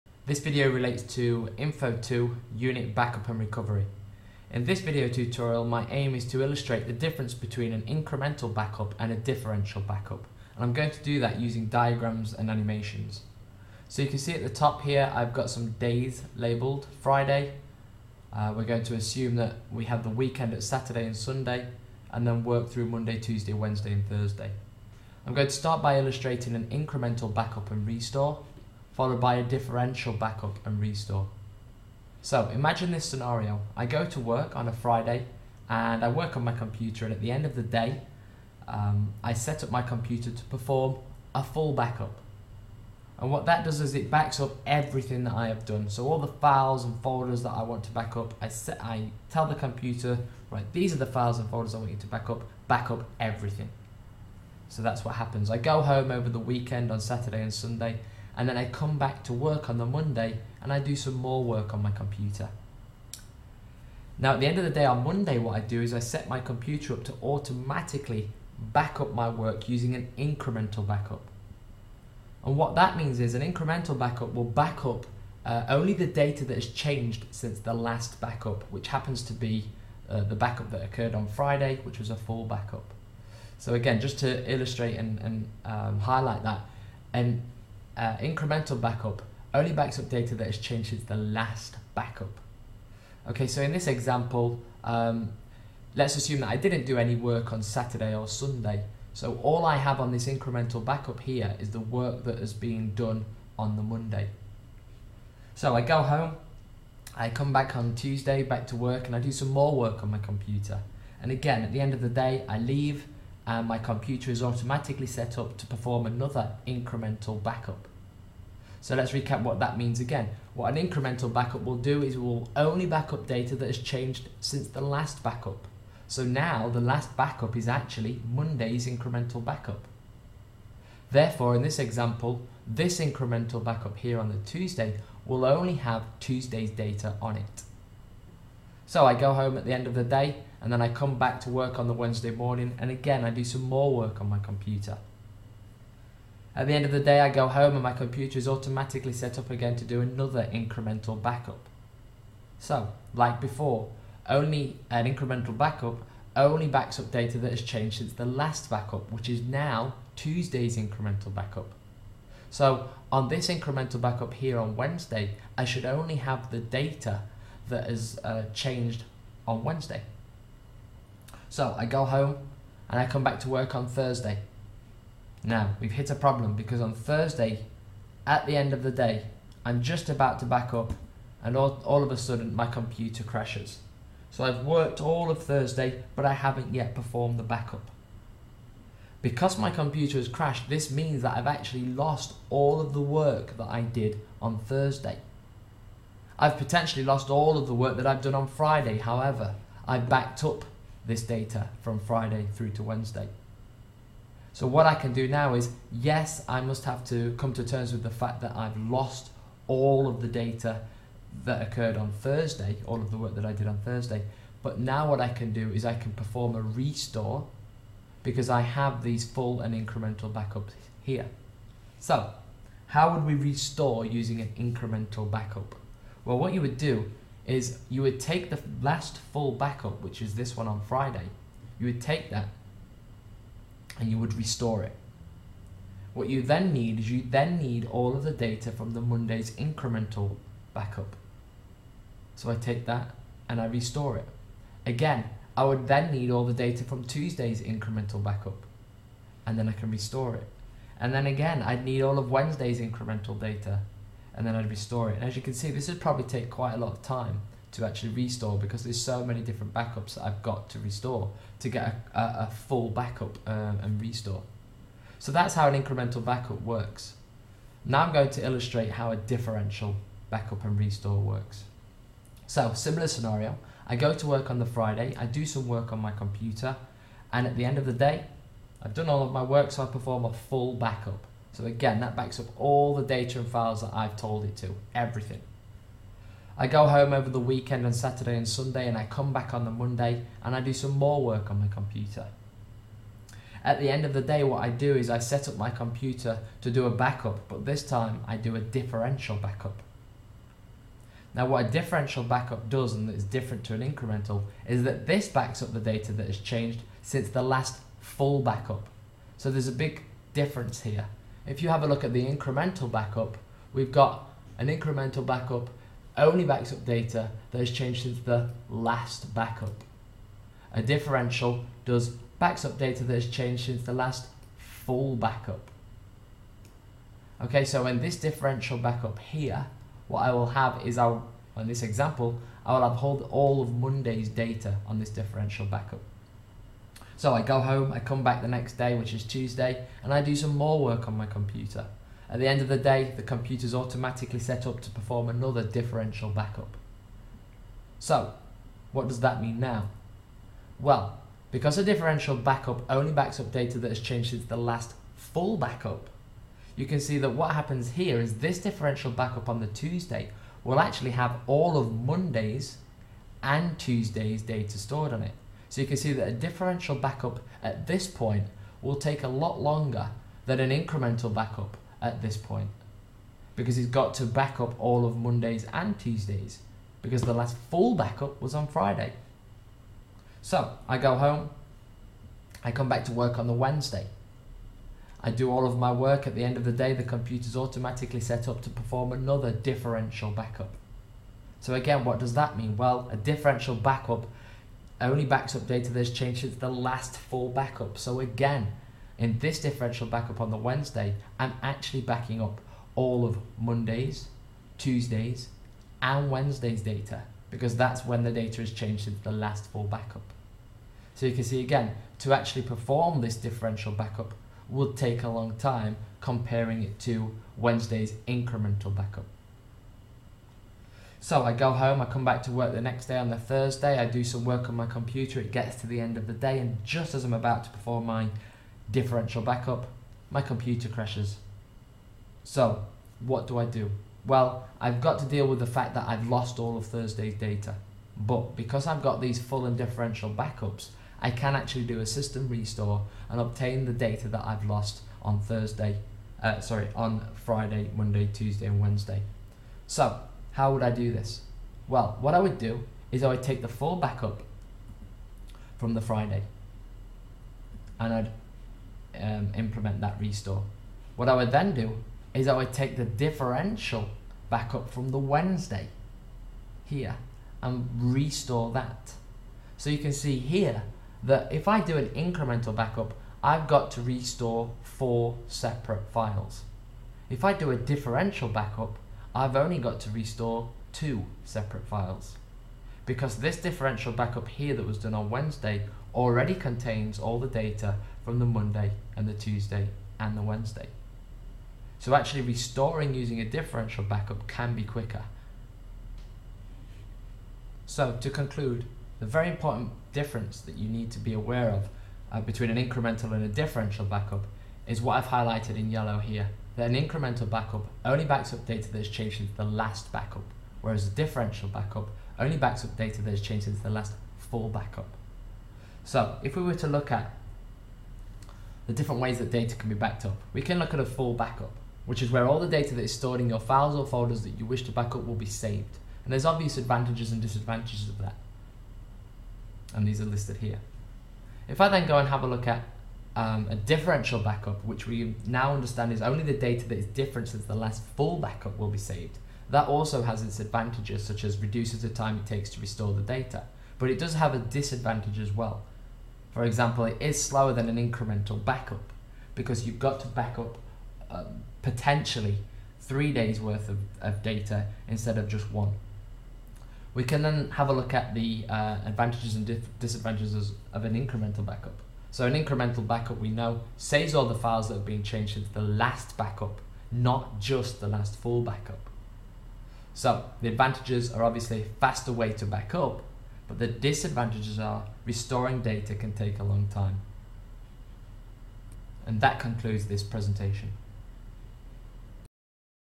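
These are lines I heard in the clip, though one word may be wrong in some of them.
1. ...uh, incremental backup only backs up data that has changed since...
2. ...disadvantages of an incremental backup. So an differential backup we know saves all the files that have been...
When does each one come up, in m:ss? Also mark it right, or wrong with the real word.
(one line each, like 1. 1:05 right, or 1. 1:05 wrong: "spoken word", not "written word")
1. 1:27 right
2. 9:19 wrong: "incremental", not "differential".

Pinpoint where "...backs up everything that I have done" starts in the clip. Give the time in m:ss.
0:44.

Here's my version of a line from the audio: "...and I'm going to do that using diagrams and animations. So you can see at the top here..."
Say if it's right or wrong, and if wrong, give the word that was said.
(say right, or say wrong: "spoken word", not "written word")
right.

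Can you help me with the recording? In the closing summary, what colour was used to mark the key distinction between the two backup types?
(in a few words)
Yellow.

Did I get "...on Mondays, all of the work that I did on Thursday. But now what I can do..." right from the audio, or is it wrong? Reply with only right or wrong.
wrong.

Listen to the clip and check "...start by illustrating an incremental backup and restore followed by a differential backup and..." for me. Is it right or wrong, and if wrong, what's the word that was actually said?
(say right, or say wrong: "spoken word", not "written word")
right.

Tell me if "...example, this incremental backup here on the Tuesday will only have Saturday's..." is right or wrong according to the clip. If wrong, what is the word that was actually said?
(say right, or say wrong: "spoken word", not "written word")
wrong: "Tuesday", not "Saturday".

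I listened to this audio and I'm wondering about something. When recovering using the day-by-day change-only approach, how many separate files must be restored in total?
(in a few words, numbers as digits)
4.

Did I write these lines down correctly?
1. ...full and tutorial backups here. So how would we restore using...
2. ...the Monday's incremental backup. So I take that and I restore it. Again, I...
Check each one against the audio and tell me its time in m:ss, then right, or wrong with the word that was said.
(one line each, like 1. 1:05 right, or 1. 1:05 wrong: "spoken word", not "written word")
1. 3:39 wrong: "incremental", not "tutorial"
2. 3:58 right.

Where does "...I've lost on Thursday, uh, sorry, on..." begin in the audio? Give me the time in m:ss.
7:24.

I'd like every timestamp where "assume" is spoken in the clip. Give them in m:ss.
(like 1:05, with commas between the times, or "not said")
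0:18, 1:36.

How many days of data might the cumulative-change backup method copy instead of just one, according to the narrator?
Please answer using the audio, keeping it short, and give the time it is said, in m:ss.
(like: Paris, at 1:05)
3, at 9:12.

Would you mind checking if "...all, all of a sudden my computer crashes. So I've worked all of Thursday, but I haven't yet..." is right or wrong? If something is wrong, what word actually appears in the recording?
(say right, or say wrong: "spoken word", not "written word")
right.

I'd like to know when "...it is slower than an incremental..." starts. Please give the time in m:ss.
9:07.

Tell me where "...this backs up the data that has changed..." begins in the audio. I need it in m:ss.
5:05.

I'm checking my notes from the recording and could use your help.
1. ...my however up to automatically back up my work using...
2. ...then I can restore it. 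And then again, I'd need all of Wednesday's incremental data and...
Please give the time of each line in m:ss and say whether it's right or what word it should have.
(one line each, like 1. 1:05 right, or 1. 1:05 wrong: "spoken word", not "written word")
1. 1:06 wrong: "computer", not "however"
2. 4:09 right.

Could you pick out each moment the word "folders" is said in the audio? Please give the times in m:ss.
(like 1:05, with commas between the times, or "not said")
0:47, 0:51, 8:44.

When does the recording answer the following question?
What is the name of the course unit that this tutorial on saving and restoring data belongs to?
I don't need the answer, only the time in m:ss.
0:01.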